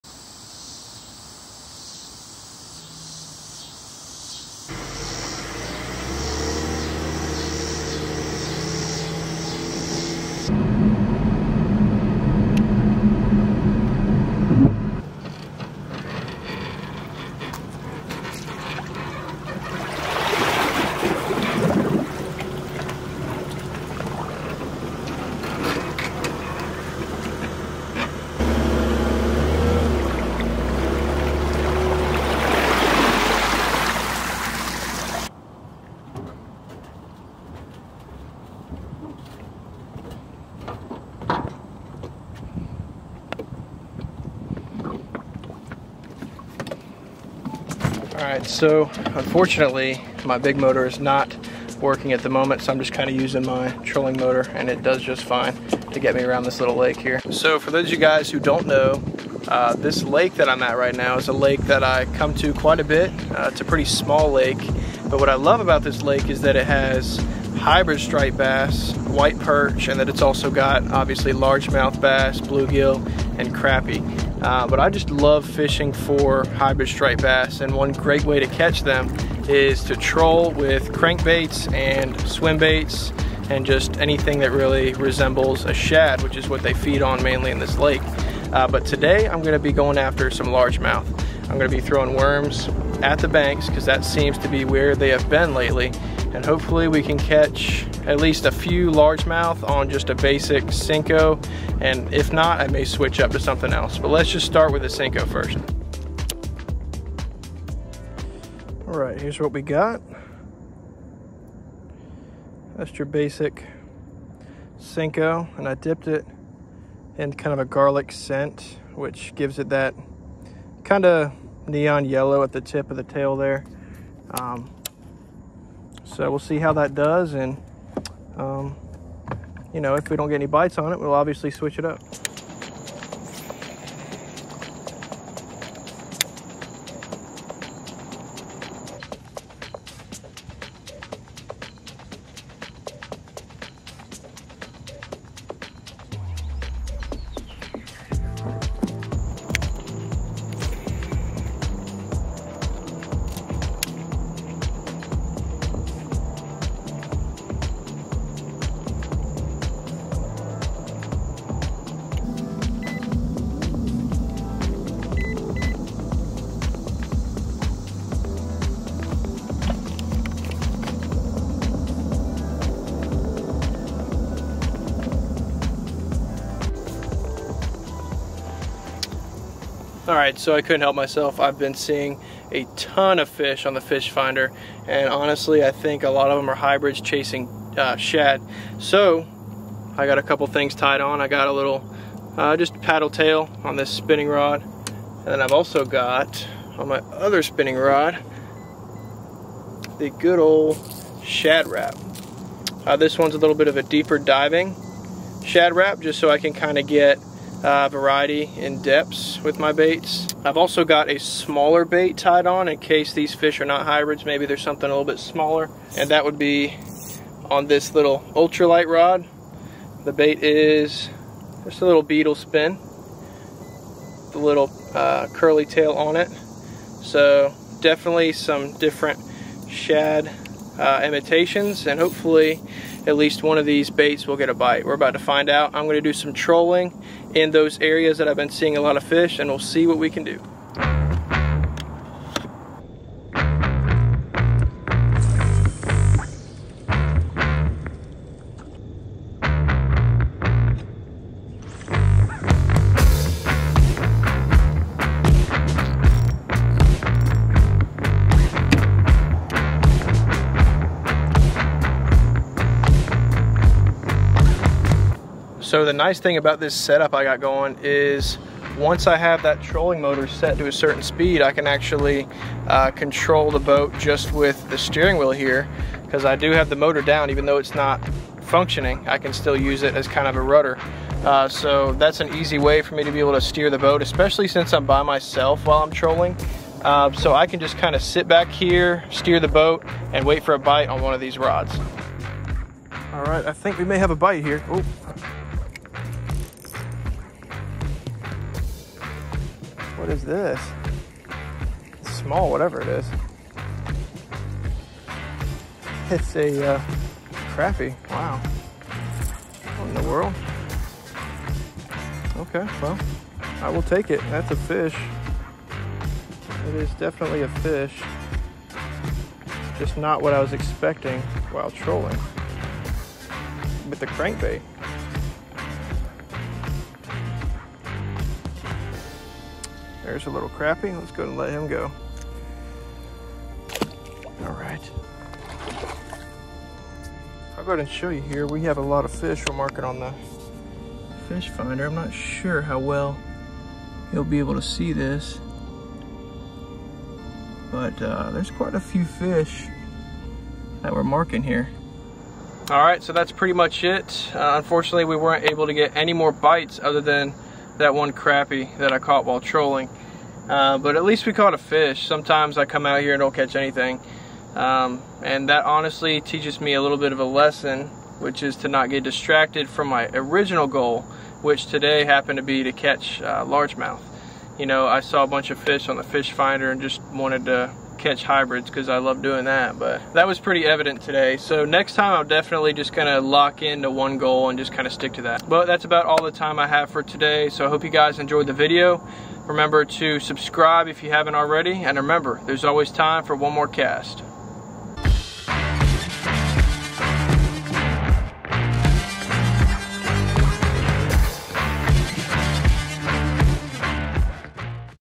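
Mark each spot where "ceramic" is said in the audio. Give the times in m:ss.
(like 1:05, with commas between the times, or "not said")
not said.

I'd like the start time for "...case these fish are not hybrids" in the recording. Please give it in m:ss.
3:32.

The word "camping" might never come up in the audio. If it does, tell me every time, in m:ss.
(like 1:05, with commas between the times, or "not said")
not said.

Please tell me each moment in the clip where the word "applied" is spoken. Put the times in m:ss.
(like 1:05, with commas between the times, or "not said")
not said.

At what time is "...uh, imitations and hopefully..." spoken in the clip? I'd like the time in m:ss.
3:50.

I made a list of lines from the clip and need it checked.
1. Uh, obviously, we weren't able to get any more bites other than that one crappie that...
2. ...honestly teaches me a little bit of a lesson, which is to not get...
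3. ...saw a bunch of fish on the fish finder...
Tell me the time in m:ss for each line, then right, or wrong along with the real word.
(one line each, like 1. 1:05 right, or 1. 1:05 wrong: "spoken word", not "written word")
1. 5:54 wrong: "unfortunately", not "obviously"
2. 6:05 right
3. 6:14 right.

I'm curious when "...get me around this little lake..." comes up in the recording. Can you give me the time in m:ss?
0:55.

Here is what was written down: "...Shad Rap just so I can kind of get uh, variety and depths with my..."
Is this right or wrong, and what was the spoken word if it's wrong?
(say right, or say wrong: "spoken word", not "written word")
right.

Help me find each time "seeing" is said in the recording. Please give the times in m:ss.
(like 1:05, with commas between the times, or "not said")
3:01, 3:58.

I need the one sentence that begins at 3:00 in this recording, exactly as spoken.
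Alright, so I couldn't help myself.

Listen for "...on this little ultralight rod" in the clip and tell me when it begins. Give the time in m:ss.
3:37.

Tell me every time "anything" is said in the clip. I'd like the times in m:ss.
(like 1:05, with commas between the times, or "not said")
1:23, 6:03.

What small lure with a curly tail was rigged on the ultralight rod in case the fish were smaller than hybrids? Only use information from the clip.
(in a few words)
Beetle spin.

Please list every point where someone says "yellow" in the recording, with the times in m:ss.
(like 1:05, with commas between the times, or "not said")
2:02.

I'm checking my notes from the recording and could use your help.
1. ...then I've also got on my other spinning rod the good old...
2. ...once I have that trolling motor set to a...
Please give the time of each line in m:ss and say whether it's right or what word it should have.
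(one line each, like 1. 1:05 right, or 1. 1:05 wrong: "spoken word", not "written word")
1. 3:15 right
2. 4:28 right.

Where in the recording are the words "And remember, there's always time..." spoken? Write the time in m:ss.
6:31.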